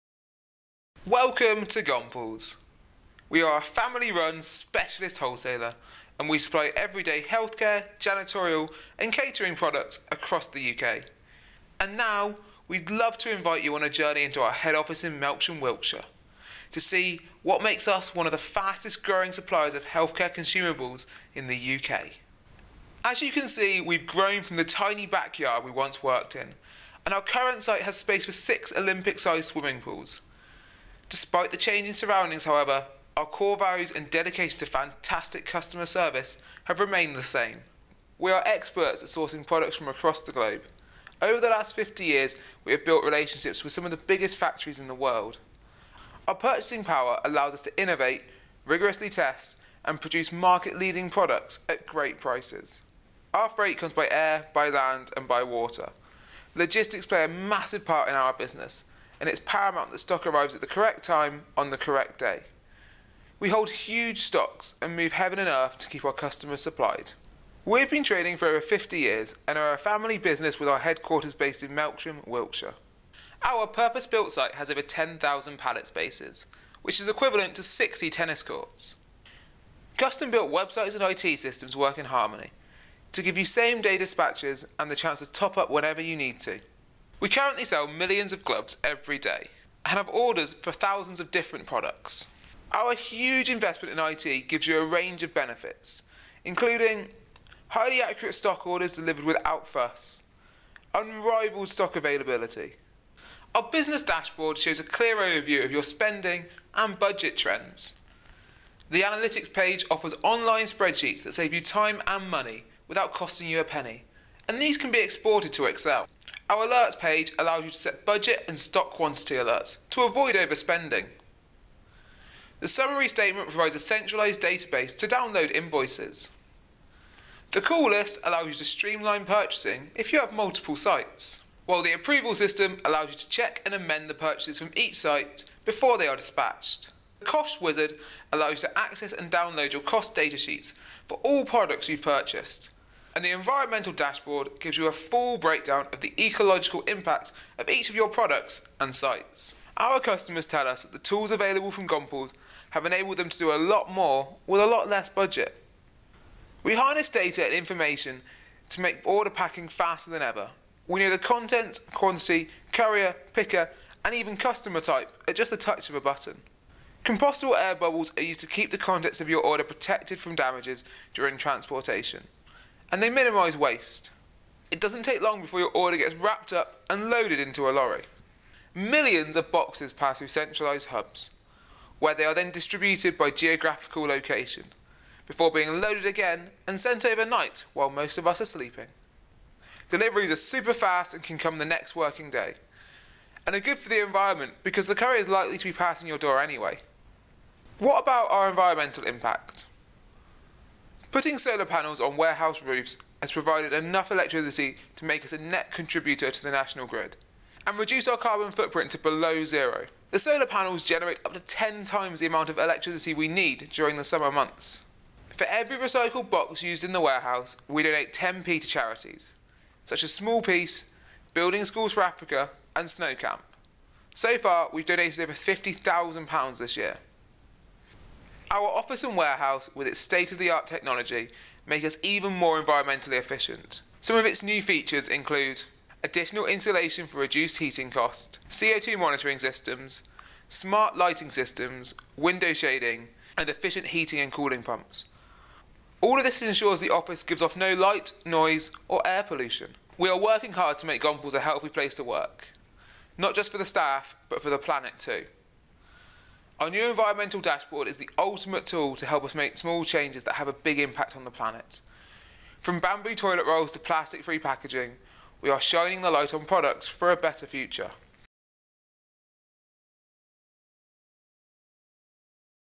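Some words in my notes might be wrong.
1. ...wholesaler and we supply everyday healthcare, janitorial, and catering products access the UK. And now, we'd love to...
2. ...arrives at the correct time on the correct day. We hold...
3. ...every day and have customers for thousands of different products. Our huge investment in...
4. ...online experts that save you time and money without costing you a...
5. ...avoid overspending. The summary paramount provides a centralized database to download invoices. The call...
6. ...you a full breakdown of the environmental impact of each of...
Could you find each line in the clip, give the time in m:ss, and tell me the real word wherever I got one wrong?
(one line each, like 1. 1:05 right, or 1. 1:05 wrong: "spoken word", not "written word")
1. 0:05 wrong: "across", not "access"
2. 1:00 right
3. 1:28 wrong: "orders", not "customers"
4. 1:50 wrong: "spreadsheets", not "experts"
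5. 2:00 wrong: "statement", not "paramount"
6. 2:24 wrong: "ecological", not "environmental".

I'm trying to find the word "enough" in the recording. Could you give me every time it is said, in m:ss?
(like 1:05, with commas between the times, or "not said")
3:23.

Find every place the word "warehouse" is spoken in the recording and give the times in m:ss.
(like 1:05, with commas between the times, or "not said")
3:22, 3:37, 3:49.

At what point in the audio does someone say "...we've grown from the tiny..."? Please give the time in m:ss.
0:23.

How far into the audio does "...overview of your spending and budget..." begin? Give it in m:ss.
1:45.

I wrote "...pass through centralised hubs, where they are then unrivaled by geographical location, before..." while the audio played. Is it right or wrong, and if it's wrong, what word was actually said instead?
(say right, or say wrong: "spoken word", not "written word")
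wrong: "distributed", not "unrivaled".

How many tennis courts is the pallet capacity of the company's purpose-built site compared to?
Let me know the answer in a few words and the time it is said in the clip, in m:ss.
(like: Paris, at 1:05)
60, at 1:17.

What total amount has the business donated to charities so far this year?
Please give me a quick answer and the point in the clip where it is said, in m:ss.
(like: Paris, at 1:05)
Over £50,000, at 3:45.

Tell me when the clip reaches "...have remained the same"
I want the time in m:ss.
0:36.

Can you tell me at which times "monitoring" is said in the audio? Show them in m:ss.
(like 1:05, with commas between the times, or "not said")
3:58.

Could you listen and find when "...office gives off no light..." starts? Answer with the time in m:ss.
4:06.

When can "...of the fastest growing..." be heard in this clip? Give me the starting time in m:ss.
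0:18.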